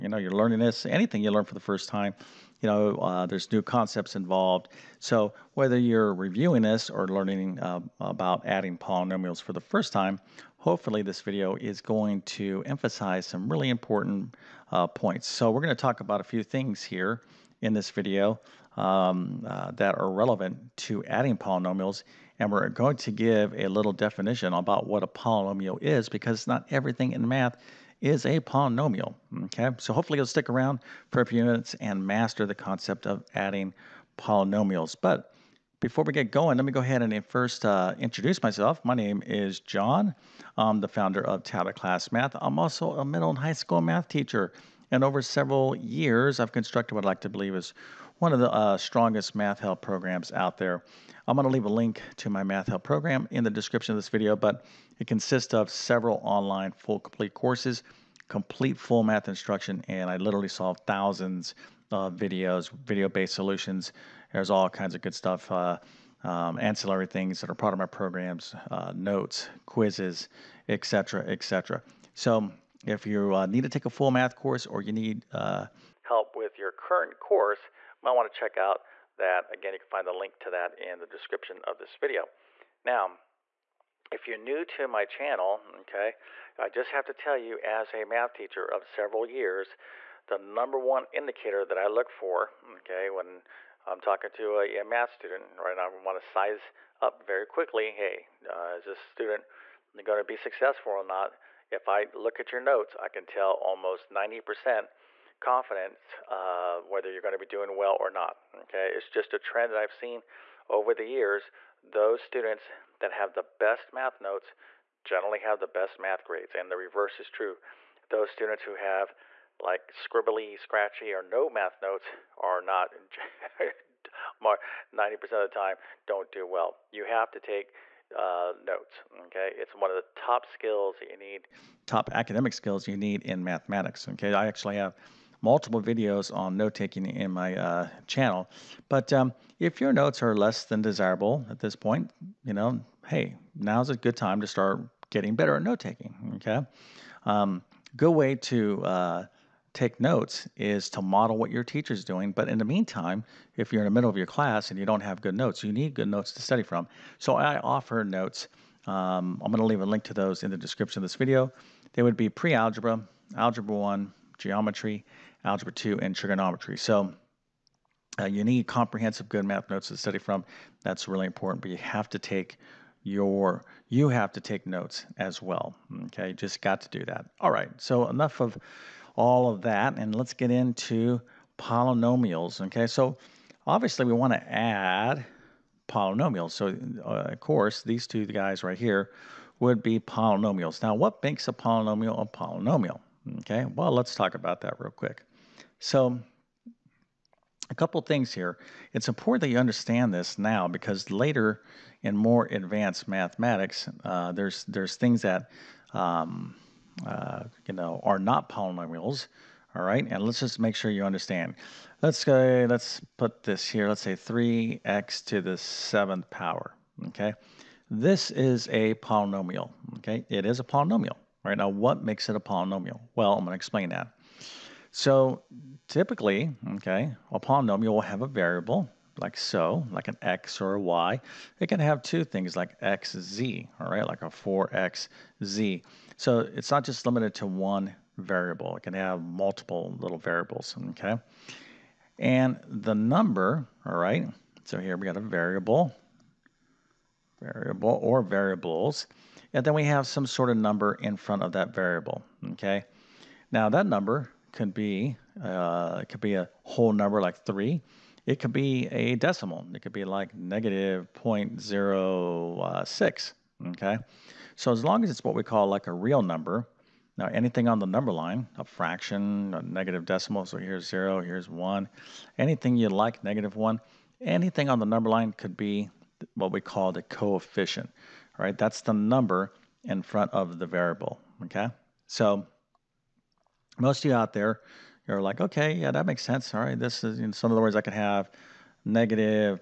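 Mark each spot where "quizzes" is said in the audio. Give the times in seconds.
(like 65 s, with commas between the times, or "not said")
69 s.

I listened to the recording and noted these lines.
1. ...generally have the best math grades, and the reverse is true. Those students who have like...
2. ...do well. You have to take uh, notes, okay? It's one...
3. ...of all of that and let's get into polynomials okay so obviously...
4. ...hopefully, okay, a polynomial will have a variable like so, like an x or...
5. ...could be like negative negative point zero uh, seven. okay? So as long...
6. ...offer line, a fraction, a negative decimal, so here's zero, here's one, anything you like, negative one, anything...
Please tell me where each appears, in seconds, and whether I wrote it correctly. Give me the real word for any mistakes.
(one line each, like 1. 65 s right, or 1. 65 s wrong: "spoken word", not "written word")
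1. 115 s right
2. 126 s right
3. 178 s right
4. 225 s wrong: "typically", not "hopefully"
5. 259 s wrong: "six", not "seven"
6. 267 s wrong: "number", not "offer".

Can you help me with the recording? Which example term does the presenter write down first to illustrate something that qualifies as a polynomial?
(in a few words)
3x to the seventh power.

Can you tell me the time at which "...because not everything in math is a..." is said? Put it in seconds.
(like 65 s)
26 s.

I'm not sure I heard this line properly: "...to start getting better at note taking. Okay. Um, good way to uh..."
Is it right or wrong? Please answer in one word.
right.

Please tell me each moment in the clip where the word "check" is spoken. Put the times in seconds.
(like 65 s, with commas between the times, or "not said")
78 s.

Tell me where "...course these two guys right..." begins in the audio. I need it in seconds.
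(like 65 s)
187 s.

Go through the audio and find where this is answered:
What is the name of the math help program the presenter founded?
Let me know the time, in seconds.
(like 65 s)
41 s.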